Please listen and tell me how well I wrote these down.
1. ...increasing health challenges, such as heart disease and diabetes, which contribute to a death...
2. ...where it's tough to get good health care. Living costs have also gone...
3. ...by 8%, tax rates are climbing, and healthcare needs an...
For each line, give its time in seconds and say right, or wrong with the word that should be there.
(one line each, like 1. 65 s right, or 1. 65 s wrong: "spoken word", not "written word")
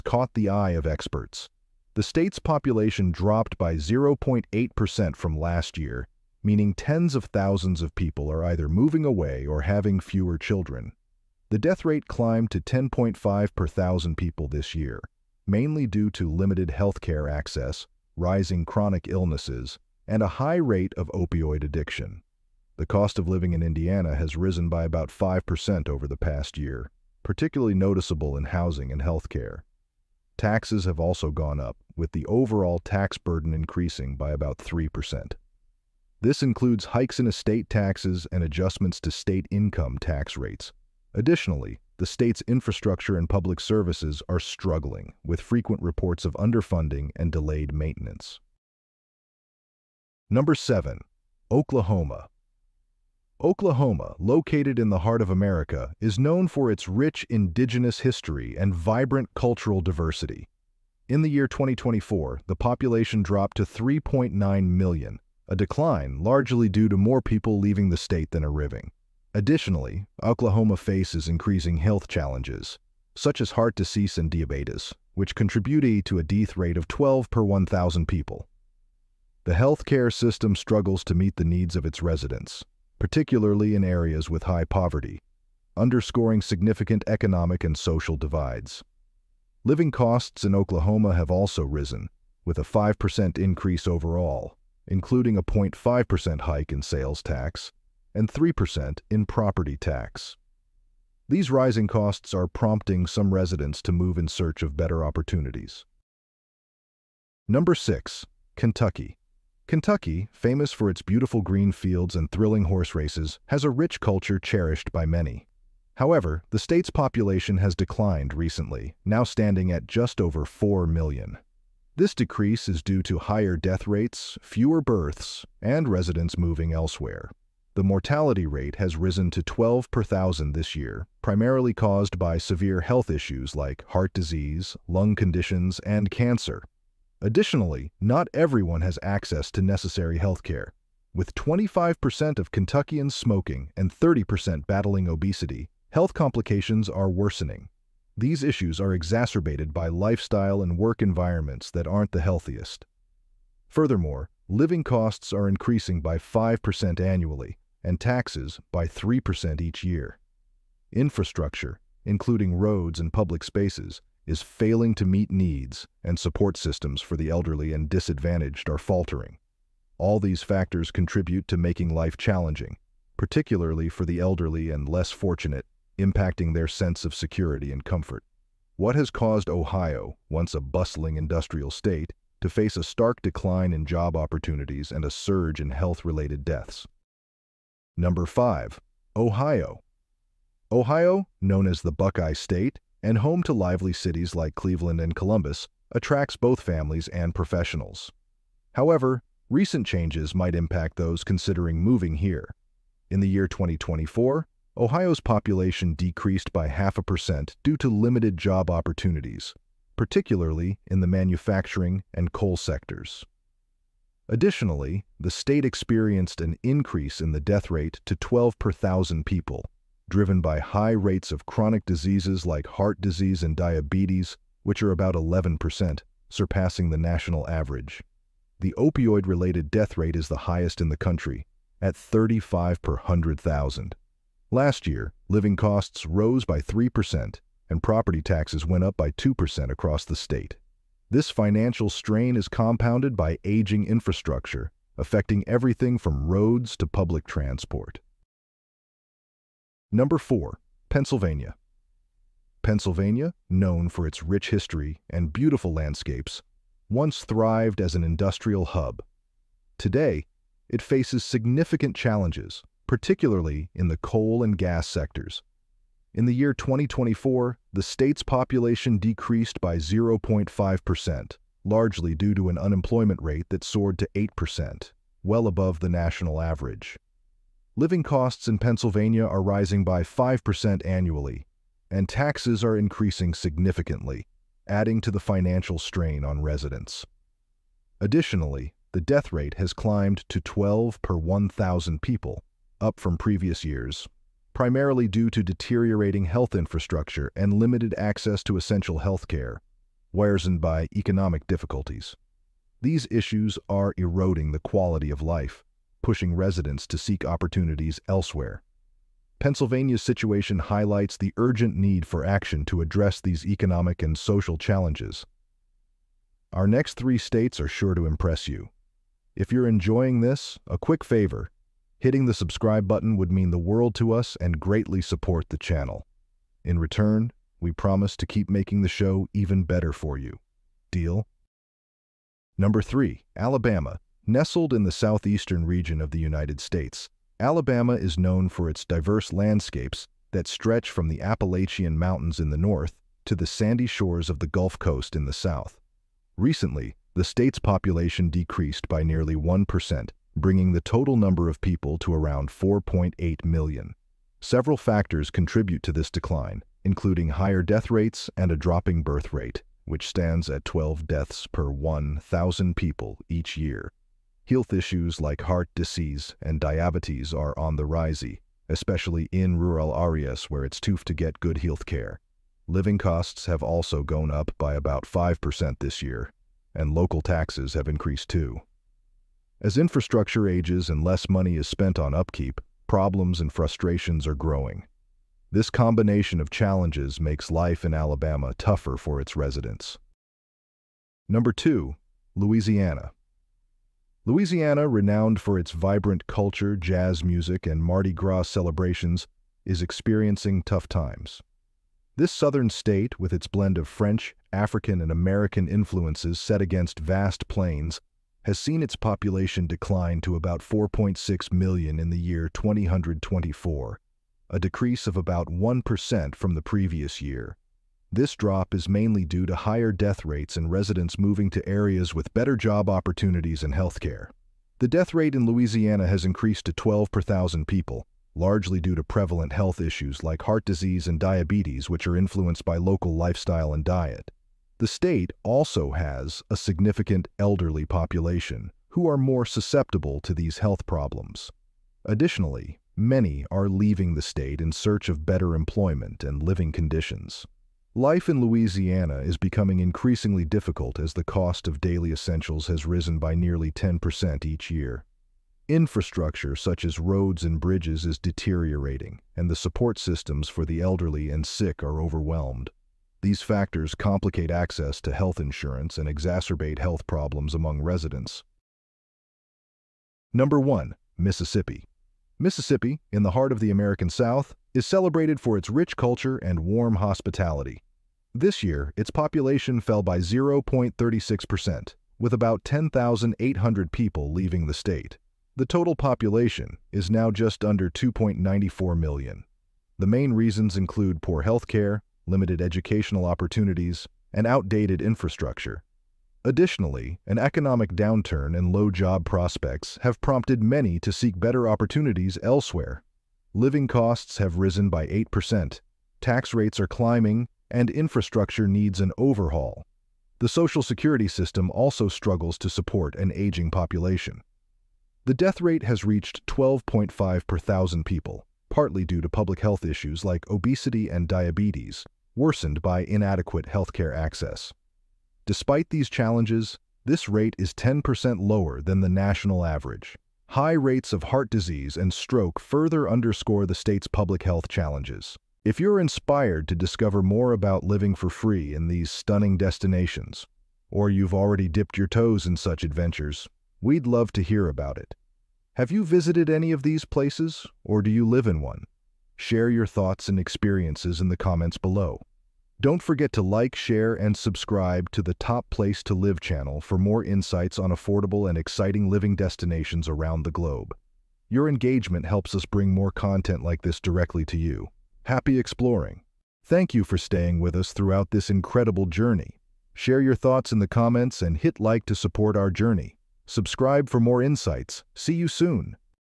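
1. 71 s right
2. 370 s right
3. 504 s wrong: "infrastructure", not "healthcare".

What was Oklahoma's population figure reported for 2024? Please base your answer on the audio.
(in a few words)
3.9 million.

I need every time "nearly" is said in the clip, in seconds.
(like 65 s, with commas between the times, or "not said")
349 s, 453 s.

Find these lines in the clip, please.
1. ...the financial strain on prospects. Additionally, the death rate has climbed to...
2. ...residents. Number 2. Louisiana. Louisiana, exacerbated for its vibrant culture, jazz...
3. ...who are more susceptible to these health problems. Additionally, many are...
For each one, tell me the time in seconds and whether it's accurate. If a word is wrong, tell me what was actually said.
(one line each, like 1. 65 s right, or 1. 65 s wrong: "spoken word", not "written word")
1. 285 s wrong: "residents", not "prospects"
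2. 389 s wrong: "renowned", not "exacerbated"
3. 438 s right.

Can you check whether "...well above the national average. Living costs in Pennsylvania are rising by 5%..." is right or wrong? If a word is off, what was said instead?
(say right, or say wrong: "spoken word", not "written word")
right.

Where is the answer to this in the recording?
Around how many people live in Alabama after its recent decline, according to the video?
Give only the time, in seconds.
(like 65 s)
352 s.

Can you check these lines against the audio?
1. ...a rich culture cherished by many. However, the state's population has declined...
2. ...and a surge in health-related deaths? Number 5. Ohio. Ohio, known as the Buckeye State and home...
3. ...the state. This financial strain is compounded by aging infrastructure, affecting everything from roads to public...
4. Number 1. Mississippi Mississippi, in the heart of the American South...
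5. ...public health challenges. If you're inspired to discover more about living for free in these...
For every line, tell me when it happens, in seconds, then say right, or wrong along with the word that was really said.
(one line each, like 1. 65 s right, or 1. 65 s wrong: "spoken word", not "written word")
1. 113 s right
2. 184 s right
3. 240 s right
4. 470 s right
5. 534 s right.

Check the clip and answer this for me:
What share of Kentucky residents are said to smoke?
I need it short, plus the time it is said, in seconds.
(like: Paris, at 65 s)
25%, at 141 s.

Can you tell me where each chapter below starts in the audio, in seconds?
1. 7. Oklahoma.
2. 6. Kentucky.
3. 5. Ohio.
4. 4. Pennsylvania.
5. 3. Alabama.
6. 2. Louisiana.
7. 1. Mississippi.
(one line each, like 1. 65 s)
1. 50 s
2. 108 s
3. 188 s
4. 250 s
5. 333 s
6. 391 s
7. 470 s.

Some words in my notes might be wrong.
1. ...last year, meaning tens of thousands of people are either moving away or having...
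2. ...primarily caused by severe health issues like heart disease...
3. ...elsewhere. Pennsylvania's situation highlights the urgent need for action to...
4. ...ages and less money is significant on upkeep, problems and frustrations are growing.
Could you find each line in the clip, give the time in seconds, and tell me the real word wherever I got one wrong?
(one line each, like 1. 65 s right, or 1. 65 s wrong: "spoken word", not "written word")
1. 5 s right
2. 131 s right
3. 308 s right
4. 380 s wrong: "spent", not "significant".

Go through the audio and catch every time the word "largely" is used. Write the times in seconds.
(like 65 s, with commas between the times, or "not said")
66 s, 271 s, 428 s.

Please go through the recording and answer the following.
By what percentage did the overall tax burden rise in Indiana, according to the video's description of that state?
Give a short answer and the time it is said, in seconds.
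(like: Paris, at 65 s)
3%, at 34 s.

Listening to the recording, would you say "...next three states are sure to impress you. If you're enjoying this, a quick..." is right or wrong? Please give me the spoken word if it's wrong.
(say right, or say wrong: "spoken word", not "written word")
right.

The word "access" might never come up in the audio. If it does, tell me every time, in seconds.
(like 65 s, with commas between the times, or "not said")
17 s, 139 s, 297 s, 464 s, 524 s.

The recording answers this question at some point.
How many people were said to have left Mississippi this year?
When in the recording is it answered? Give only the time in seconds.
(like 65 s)
482 s.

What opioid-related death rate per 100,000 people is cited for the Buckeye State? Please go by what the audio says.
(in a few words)
35.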